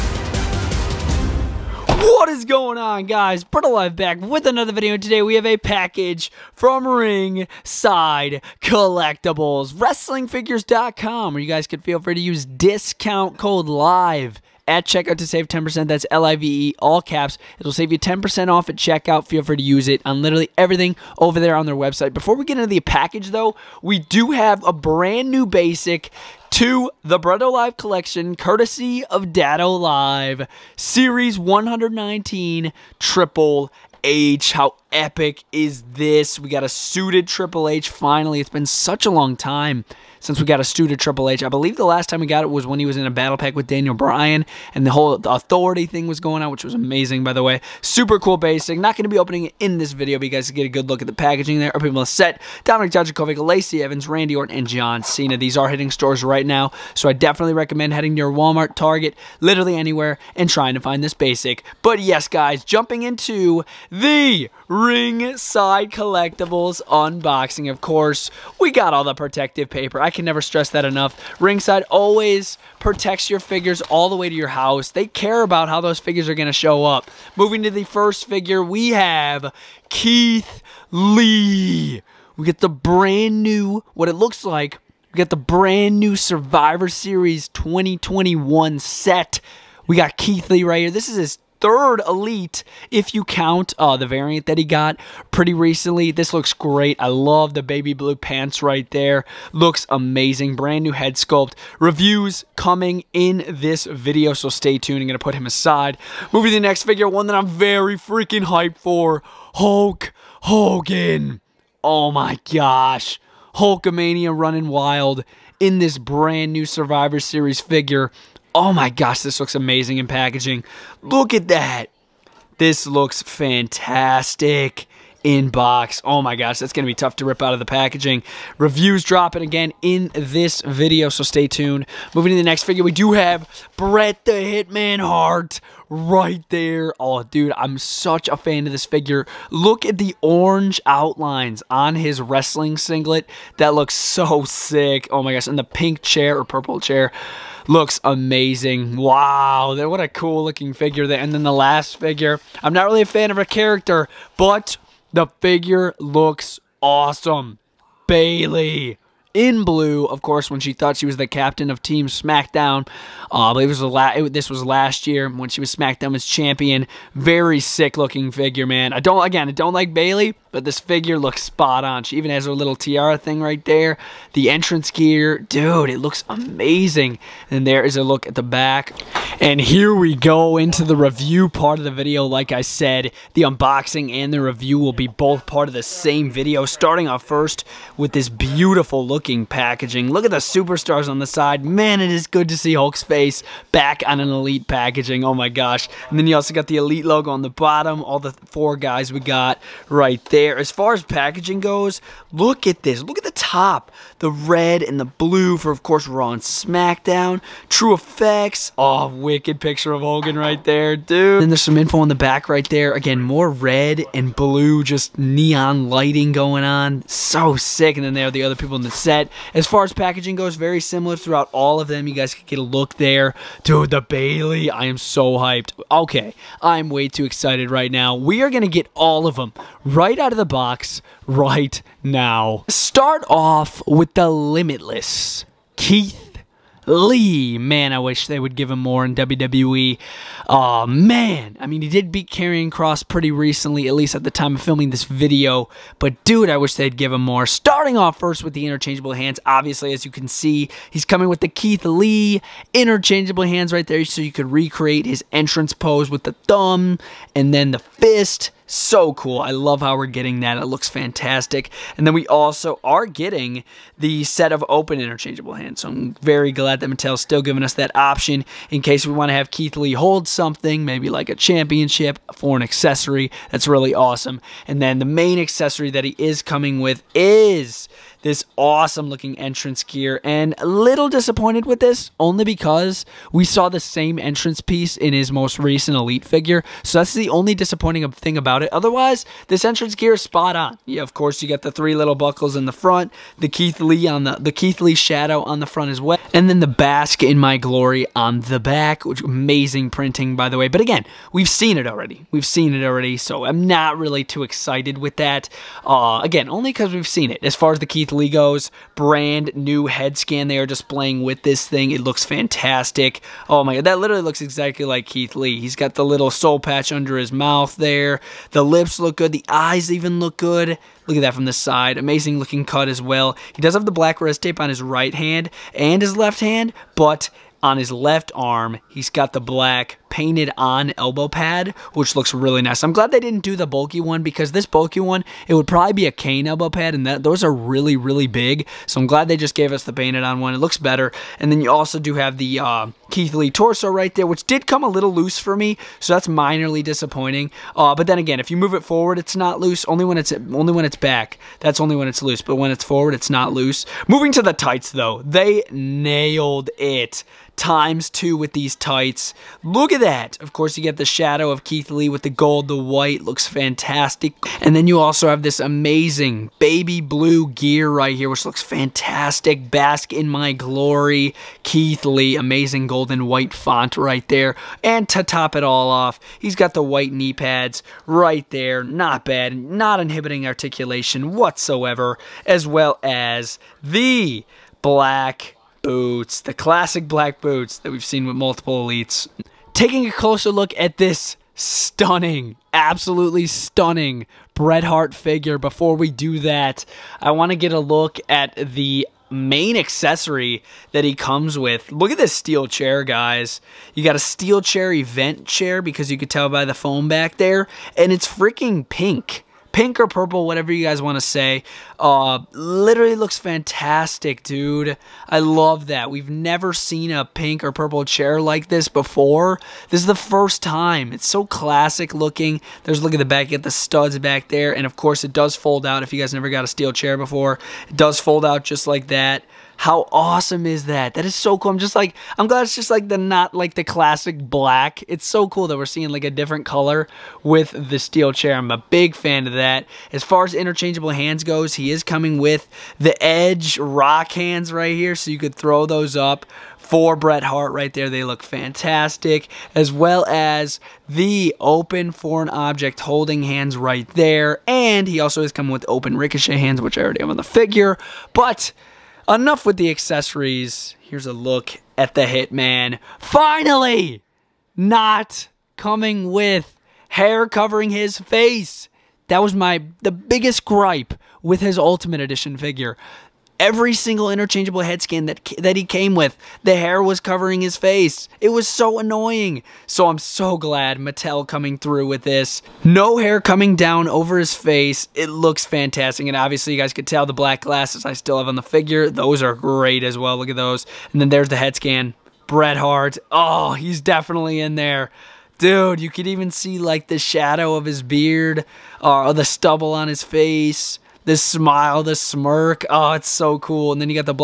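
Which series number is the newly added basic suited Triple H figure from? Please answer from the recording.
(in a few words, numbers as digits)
119.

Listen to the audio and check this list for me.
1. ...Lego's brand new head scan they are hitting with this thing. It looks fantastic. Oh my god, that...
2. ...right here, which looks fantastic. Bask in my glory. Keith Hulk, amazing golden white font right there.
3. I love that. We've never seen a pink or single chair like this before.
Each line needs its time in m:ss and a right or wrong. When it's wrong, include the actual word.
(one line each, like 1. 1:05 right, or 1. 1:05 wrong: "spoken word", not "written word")
1. 5:08 wrong: "displaying", not "hitting"
2. 6:07 wrong: "Lee", not "Hulk"
3. 6:55 wrong: "purple", not "single".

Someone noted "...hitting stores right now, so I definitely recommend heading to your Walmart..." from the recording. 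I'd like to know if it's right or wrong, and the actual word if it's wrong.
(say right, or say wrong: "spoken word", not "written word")
right.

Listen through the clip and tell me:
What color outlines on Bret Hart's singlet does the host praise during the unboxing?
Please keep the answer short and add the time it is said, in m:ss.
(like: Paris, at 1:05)
orange, at 2:20.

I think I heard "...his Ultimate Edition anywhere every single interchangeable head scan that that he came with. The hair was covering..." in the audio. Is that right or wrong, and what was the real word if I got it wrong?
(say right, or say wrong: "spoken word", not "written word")
wrong: "figure", not "anywhere".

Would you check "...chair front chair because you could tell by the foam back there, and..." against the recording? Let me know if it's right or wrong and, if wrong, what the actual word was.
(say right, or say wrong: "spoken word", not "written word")
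wrong: "event", not "front".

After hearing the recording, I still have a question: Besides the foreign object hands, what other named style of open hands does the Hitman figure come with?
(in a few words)
ricochet hands.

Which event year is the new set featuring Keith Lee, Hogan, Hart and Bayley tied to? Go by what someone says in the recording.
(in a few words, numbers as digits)
2021.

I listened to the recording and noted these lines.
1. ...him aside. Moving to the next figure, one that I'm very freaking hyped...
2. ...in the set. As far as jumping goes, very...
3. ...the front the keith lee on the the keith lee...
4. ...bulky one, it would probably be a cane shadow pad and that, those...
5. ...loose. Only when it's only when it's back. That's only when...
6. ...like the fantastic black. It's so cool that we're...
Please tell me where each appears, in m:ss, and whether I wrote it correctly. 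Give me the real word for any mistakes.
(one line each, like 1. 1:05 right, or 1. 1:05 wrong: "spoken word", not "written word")
1. 1:45 right
2. 3:38 wrong: "packaging", not "jumping"
3. 4:52 right
4. 5:34 wrong: "elbow", not "shadow"
5. 5:49 right
6. 7:13 wrong: "classic", not "fantastic".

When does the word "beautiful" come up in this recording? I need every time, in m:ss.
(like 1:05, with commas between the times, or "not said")
3:08.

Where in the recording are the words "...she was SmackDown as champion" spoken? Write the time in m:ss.
2:45.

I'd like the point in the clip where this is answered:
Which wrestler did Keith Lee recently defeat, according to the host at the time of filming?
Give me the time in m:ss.
4:02.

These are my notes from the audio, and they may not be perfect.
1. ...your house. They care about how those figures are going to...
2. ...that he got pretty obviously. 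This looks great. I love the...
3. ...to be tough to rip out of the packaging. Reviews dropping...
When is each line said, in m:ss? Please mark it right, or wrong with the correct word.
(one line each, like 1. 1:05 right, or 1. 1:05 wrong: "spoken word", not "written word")
1. 1:14 right
2. 1:34 wrong: "recently", not "obviously"
3. 2:06 right.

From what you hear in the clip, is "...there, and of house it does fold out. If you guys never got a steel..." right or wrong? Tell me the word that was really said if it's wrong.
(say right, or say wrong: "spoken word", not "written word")
wrong: "course", not "house".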